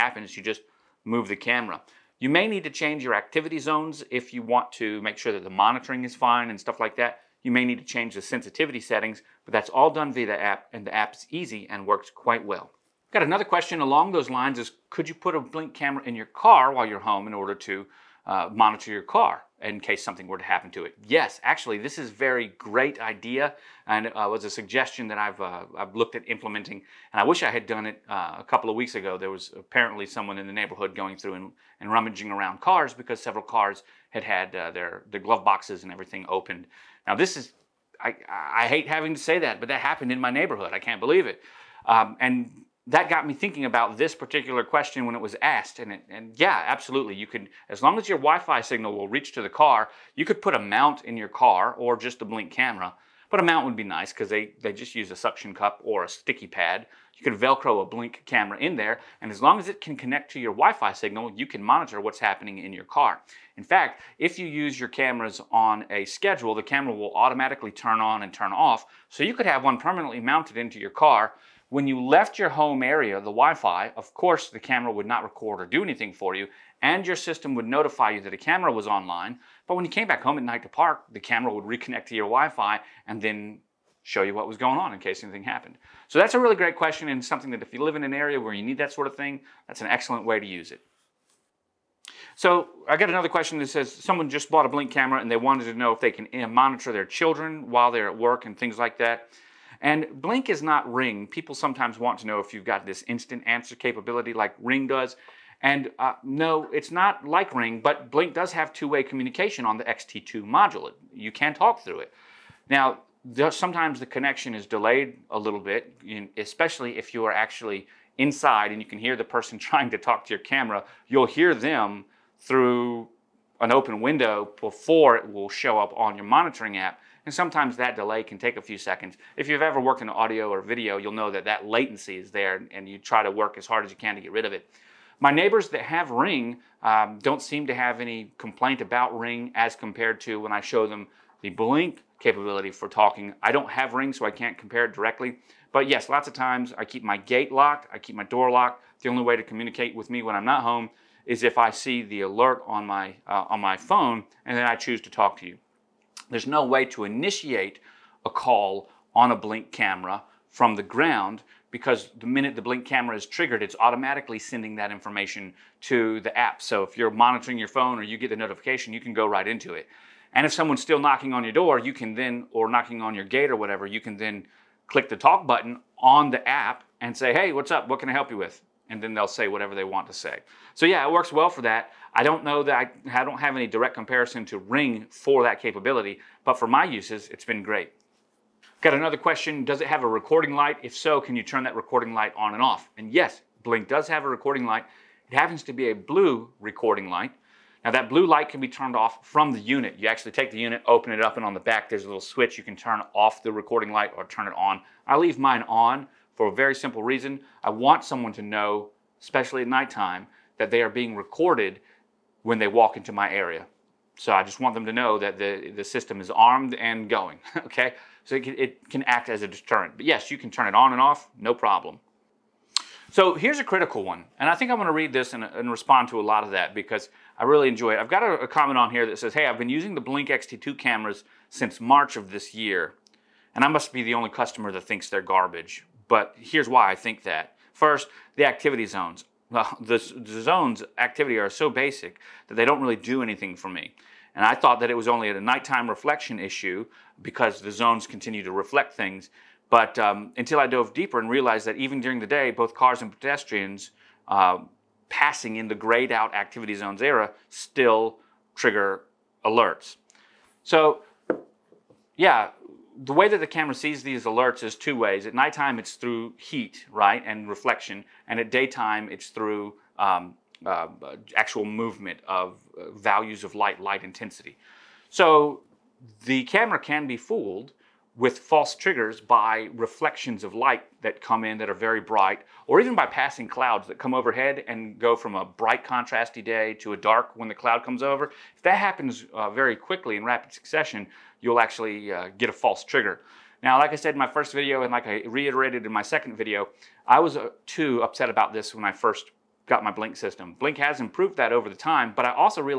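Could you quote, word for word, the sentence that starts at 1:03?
In fact, if you use your cameras on a schedule, the camera will automatically turn on and turn off.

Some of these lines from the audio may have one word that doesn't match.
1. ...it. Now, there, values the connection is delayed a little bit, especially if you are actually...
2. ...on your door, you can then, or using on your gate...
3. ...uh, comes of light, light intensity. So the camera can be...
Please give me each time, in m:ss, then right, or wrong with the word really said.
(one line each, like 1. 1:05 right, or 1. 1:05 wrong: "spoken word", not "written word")
1. 1:51 wrong: "sometimes", not "values"
2. 2:51 wrong: "knocking", not "using"
3. 4:32 wrong: "values", not "comes".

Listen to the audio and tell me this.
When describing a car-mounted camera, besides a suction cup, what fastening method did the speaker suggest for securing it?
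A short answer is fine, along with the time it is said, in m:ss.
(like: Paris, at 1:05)
Velcro, at 0:57.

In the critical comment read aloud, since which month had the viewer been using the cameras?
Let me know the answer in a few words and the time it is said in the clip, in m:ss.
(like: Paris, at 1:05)
March, at 3:51.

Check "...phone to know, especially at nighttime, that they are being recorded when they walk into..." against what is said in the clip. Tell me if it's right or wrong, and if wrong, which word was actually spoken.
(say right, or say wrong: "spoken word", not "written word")
wrong: "someone", not "phone".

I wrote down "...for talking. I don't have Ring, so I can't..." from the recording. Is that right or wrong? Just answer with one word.
right.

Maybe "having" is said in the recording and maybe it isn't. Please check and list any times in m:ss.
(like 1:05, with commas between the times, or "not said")
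0:38.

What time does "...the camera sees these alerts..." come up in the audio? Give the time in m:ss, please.
4:23.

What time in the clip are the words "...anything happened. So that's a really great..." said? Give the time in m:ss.
1:25.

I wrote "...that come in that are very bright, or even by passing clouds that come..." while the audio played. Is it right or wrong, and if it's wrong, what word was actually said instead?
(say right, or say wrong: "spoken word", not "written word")
right.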